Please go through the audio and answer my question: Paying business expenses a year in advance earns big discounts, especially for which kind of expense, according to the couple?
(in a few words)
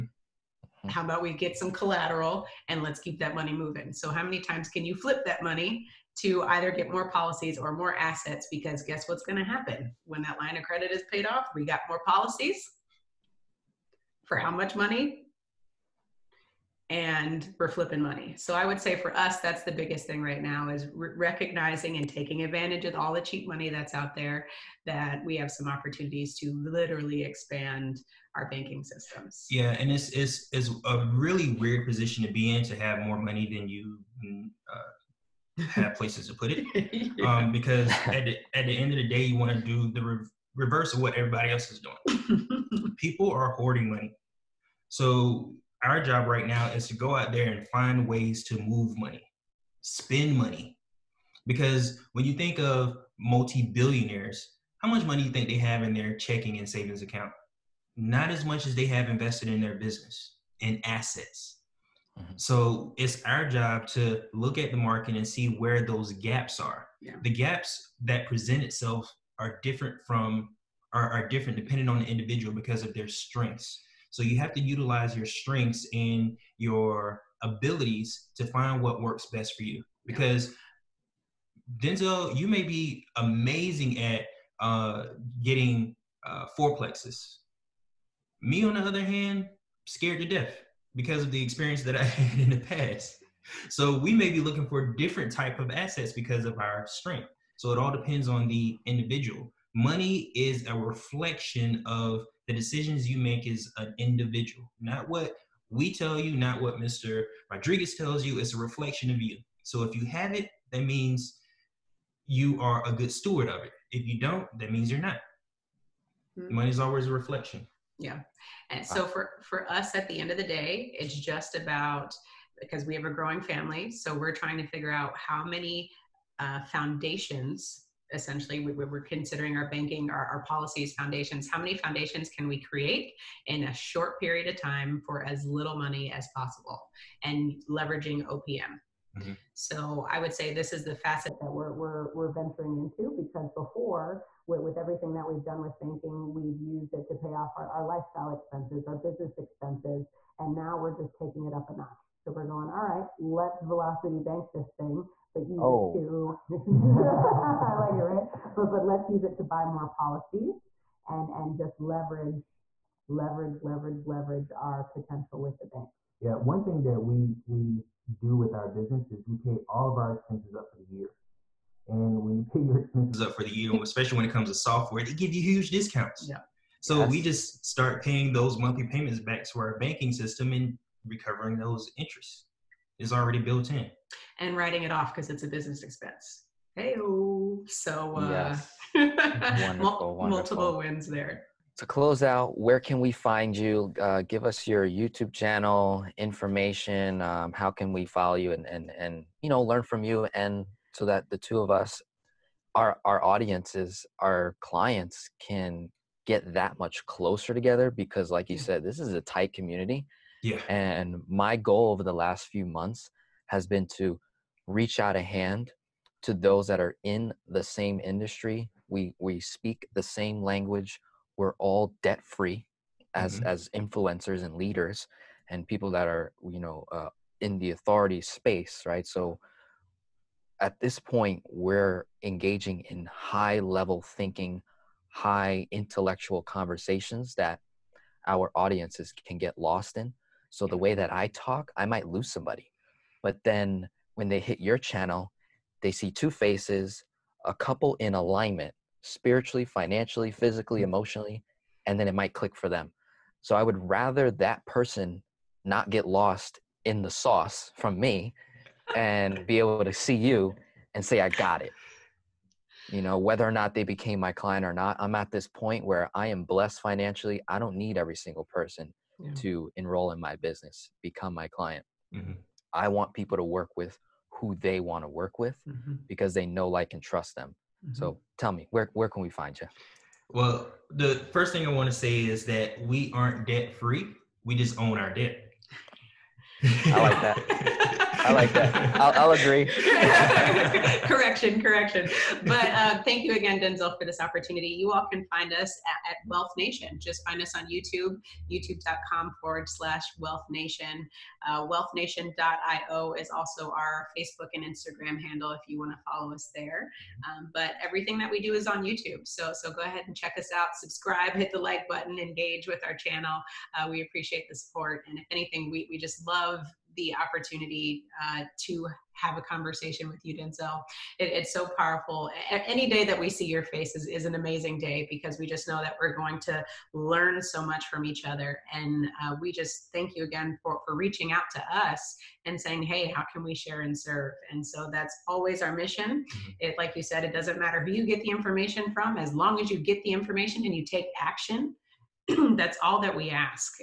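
Software.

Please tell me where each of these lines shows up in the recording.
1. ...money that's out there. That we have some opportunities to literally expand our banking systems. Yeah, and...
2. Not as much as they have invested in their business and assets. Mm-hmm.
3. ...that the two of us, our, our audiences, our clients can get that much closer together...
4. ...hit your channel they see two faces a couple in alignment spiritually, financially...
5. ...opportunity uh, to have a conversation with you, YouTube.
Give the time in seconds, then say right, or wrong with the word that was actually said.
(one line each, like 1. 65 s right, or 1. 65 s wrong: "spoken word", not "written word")
1. 23 s right
2. 57 s right
3. 201 s right
4. 244 s right
5. 317 s wrong: "Denzel", not "YouTube".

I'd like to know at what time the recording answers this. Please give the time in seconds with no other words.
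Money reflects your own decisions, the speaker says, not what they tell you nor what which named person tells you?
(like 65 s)
106 s.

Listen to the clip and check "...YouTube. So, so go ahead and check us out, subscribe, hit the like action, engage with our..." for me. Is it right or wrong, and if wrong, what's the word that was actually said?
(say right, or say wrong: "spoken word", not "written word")
wrong: "button", not "action".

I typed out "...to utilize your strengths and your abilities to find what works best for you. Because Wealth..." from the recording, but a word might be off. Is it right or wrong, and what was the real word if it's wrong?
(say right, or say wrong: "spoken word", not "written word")
wrong: "Denzel", not "Wealth".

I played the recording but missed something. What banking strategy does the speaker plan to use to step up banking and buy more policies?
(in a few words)
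Velocity bank.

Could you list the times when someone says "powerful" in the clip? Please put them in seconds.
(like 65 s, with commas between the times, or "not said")
321 s.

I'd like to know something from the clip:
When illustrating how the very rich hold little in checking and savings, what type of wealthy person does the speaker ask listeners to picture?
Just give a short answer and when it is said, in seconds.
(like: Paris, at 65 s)
Multi billionaires, at 53 s.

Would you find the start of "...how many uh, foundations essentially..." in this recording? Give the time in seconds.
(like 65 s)
125 s.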